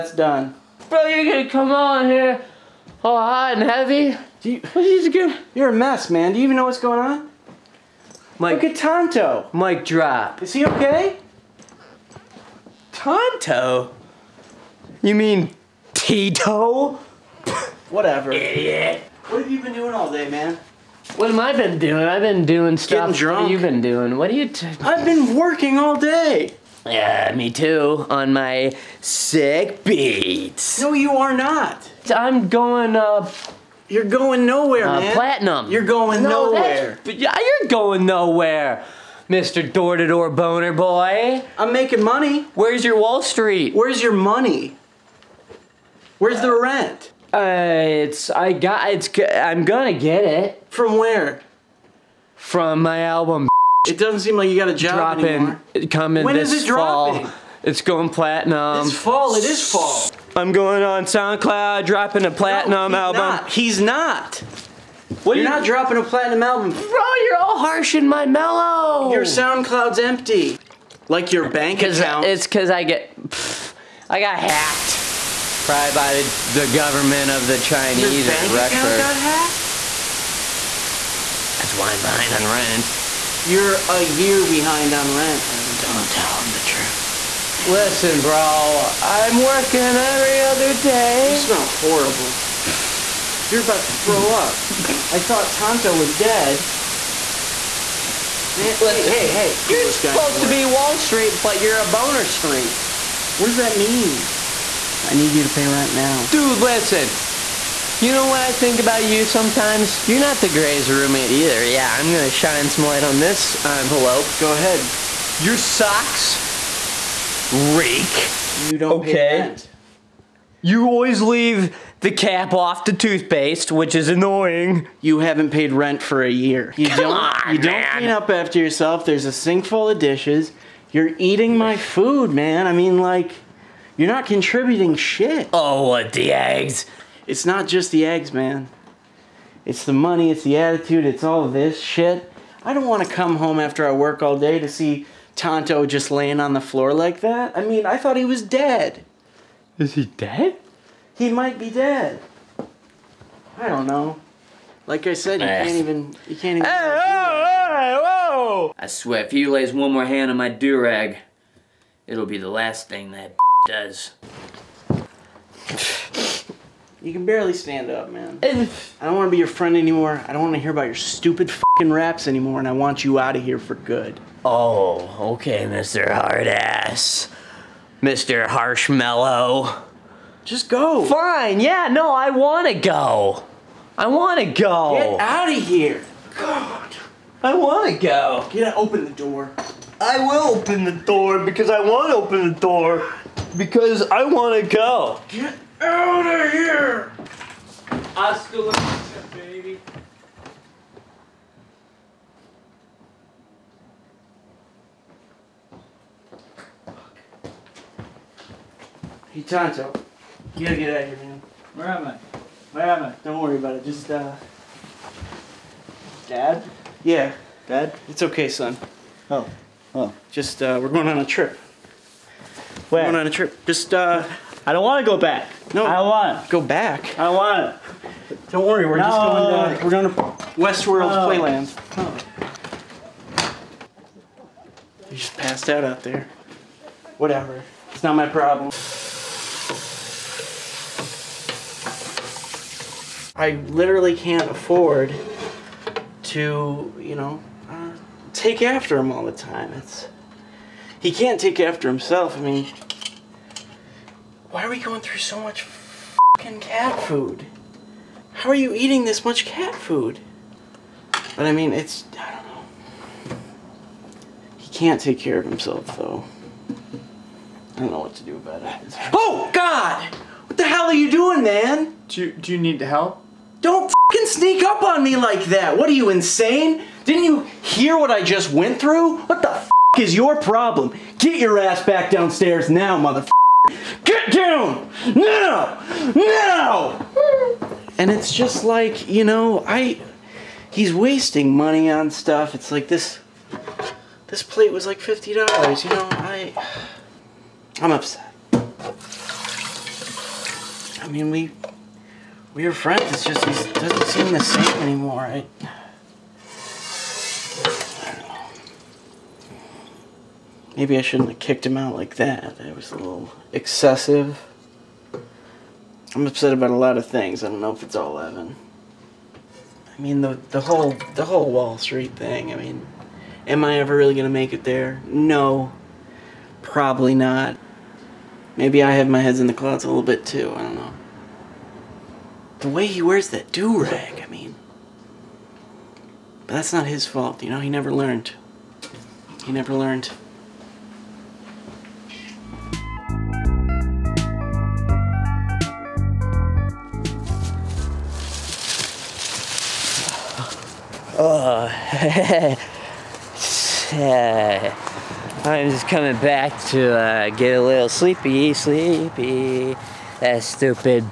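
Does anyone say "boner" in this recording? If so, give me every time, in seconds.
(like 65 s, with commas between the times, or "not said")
40 s, 101 s.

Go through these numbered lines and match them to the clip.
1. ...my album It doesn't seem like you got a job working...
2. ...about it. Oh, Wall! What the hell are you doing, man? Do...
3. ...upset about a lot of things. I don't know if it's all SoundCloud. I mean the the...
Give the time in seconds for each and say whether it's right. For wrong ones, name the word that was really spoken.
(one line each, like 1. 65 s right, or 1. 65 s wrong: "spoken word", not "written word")
1. 52 s wrong: "dropping", not "working"
2. 268 s wrong: "God", not "Wall"
3. 316 s wrong: "Evan", not "SoundCloud".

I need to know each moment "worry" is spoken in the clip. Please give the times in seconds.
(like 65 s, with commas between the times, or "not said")
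213 s, 228 s.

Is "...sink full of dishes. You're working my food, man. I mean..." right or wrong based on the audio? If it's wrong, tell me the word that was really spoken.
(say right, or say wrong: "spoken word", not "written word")
wrong: "eating", not "working".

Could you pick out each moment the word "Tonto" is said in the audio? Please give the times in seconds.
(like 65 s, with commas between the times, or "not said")
8 s, 12 s, 95 s, 145 s, 209 s.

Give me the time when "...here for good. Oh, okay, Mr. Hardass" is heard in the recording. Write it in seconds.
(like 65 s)
173 s.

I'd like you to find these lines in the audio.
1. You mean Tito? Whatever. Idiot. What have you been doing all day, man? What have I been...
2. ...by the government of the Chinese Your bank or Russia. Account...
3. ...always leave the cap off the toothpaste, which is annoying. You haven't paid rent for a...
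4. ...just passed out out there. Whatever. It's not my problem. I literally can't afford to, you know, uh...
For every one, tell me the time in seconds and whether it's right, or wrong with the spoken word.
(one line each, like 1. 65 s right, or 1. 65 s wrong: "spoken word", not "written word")
1. 15 s right
2. 75 s right
3. 120 s right
4. 235 s right.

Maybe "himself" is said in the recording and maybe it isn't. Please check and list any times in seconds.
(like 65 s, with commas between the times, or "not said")
251 s, 265 s.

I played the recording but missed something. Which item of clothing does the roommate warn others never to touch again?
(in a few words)
Durag.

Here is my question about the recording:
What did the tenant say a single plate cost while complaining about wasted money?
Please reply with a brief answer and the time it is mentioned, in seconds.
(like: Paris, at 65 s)
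$50, at 294 s.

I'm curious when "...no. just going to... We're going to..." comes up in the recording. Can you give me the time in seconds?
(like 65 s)
228 s.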